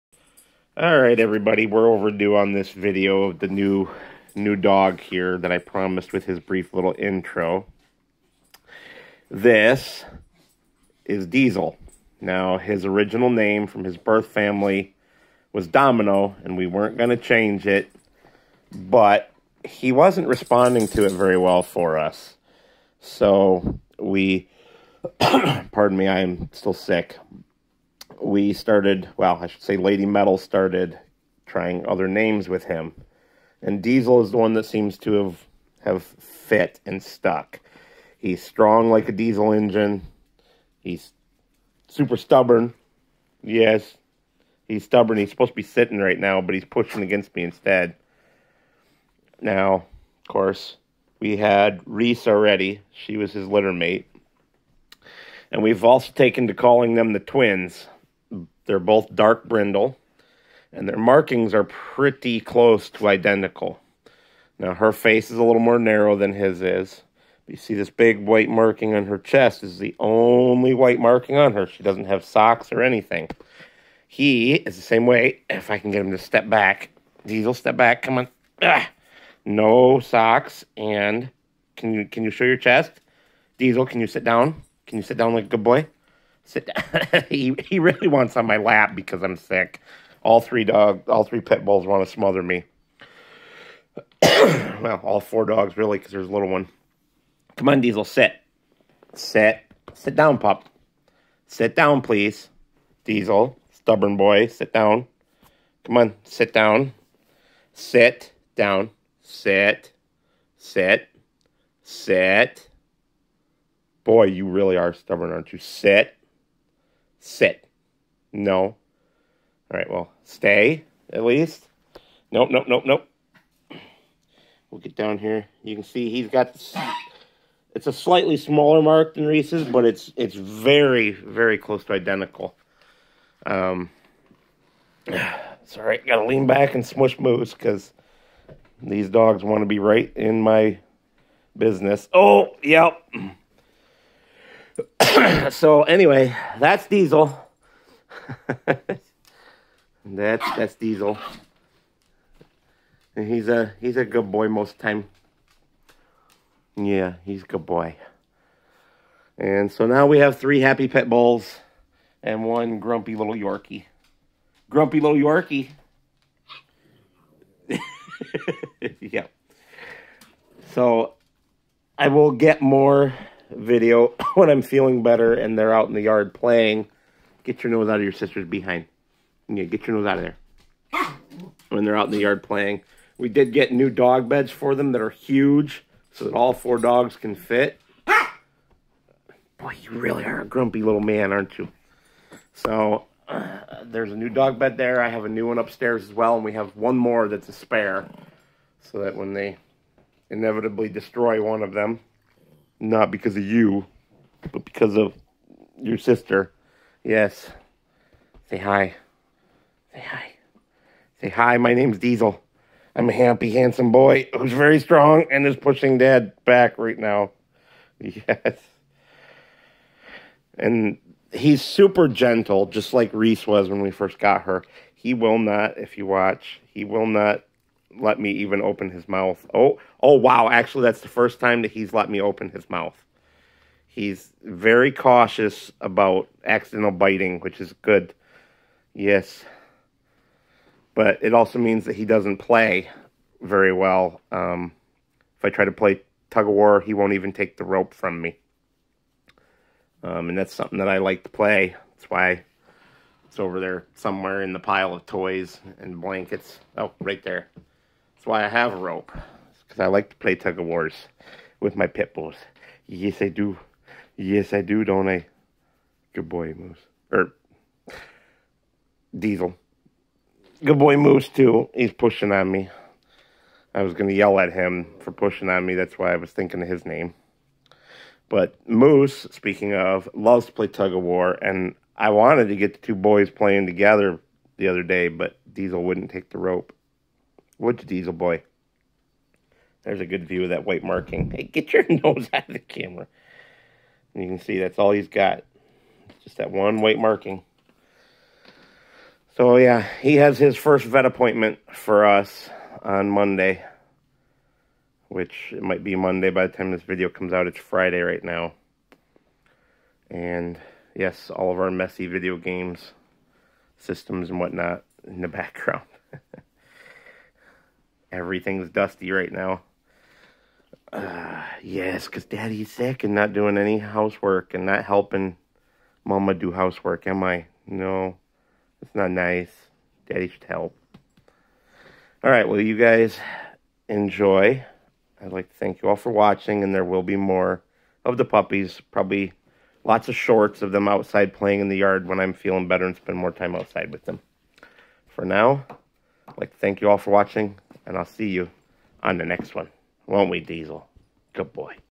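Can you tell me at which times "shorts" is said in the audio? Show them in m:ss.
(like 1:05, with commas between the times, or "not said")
5:40.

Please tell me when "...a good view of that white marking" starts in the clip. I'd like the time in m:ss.
4:50.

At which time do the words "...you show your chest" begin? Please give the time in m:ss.
1:22.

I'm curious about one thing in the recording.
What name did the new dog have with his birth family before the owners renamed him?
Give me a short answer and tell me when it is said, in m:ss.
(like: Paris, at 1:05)
Domino, at 0:15.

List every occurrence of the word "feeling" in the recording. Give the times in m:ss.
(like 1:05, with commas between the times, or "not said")
2:54, 5:42.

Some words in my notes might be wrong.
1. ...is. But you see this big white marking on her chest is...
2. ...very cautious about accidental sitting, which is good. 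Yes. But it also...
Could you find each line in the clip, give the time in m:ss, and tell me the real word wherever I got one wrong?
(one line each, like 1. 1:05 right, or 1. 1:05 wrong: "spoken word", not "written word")
1. 1:06 right
2. 3:54 wrong: "biting", not "sitting".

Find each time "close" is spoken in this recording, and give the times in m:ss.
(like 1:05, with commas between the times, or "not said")
1:02, 2:11.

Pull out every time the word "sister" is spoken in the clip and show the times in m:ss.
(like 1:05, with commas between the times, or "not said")
2:58, 3:25.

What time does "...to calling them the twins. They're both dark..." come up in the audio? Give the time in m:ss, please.
0:56.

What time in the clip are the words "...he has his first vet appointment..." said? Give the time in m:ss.
5:00.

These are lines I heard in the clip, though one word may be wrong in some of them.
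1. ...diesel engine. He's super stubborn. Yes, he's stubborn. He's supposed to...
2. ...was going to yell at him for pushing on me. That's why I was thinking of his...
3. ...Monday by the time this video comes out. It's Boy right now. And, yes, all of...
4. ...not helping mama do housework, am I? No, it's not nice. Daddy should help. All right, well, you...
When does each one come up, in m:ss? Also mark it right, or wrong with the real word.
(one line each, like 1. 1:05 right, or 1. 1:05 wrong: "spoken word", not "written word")
1. 0:39 right
2. 4:33 right
3. 5:05 wrong: "Friday", not "Boy"
4. 5:24 right.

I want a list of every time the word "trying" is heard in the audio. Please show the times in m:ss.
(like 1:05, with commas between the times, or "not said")
0:31.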